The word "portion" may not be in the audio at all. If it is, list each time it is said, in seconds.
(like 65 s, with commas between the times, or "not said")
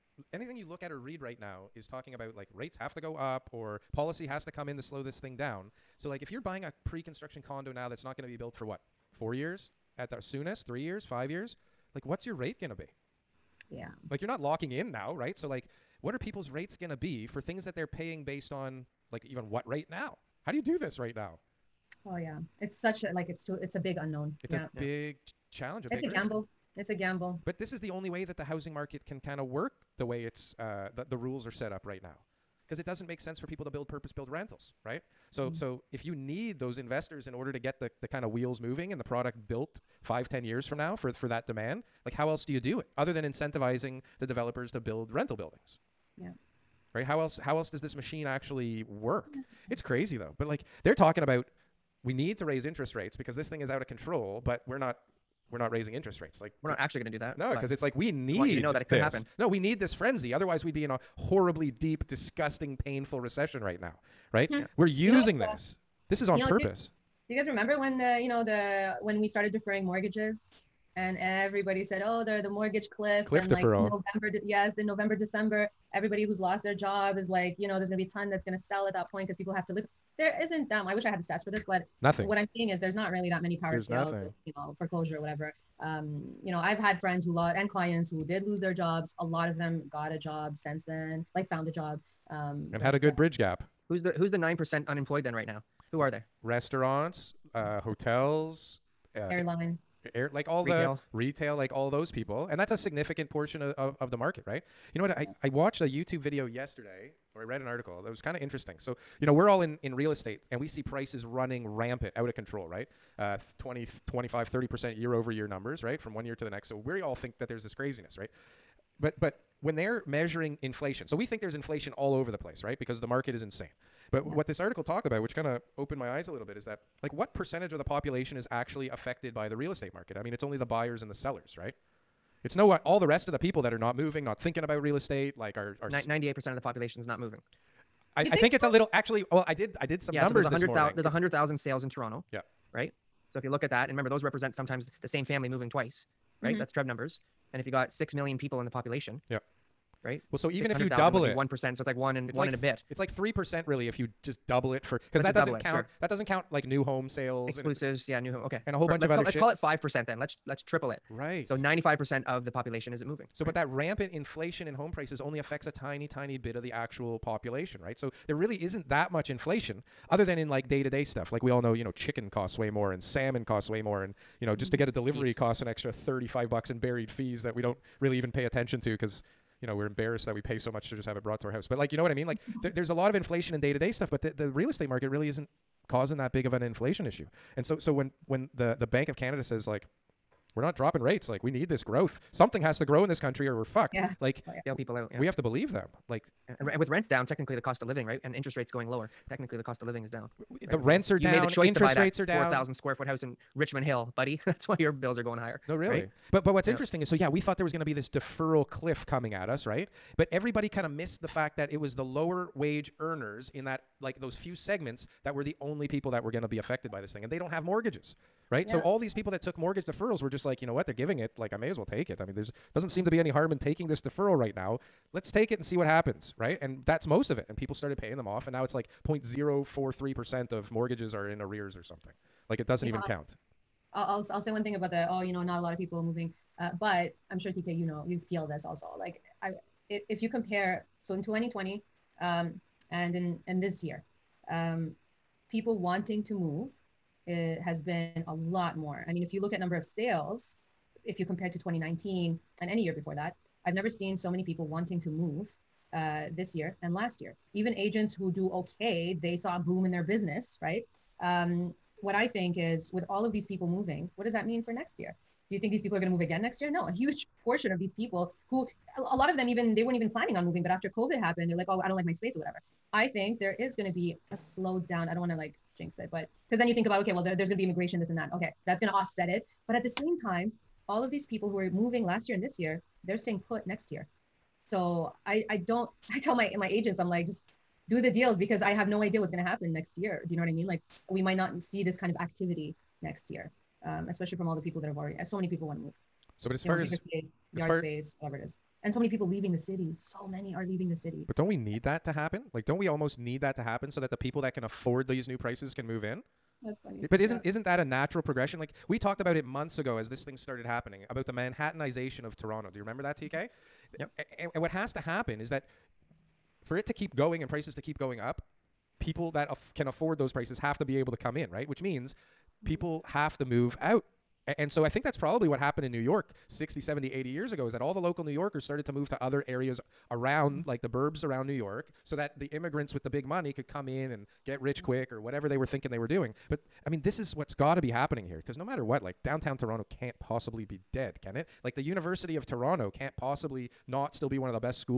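103 s, 267 s.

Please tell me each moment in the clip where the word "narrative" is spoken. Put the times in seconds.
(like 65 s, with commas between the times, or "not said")
not said.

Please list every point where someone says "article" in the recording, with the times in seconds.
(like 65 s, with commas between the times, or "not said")
107 s, 124 s.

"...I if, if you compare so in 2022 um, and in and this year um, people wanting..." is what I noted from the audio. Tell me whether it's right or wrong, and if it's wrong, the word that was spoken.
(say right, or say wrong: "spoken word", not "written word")
wrong: "2020", not "2022".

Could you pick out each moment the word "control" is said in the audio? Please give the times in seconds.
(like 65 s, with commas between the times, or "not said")
53 s, 112 s.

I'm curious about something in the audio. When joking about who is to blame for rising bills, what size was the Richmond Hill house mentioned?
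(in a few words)
4,000 square feet.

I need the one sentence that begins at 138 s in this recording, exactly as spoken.
I, think, I think it's a little actually.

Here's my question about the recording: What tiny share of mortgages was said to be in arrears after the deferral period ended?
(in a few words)
0.043%.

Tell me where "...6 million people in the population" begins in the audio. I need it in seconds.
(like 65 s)
147 s.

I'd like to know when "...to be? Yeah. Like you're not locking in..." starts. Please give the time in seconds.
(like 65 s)
12 s.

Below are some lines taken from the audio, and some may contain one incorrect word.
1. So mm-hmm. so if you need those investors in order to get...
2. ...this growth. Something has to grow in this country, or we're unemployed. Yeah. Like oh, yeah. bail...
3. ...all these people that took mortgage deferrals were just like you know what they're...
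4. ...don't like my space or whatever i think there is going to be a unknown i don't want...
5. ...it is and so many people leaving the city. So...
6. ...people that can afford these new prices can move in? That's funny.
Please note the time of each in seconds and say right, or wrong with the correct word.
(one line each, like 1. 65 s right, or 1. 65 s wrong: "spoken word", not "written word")
1. 35 s right
2. 191 s wrong: "fucked", not "unemployed"
3. 218 s right
4. 271 s wrong: "slowdown", not "unknown"
5. 298 s right
6. 304 s right.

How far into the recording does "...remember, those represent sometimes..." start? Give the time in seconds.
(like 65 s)
143 s.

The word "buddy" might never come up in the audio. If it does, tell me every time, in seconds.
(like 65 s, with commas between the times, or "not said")
204 s.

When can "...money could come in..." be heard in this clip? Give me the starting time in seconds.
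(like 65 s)
333 s.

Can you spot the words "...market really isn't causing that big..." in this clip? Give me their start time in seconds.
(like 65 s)
184 s.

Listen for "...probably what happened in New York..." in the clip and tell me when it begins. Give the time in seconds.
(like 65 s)
325 s.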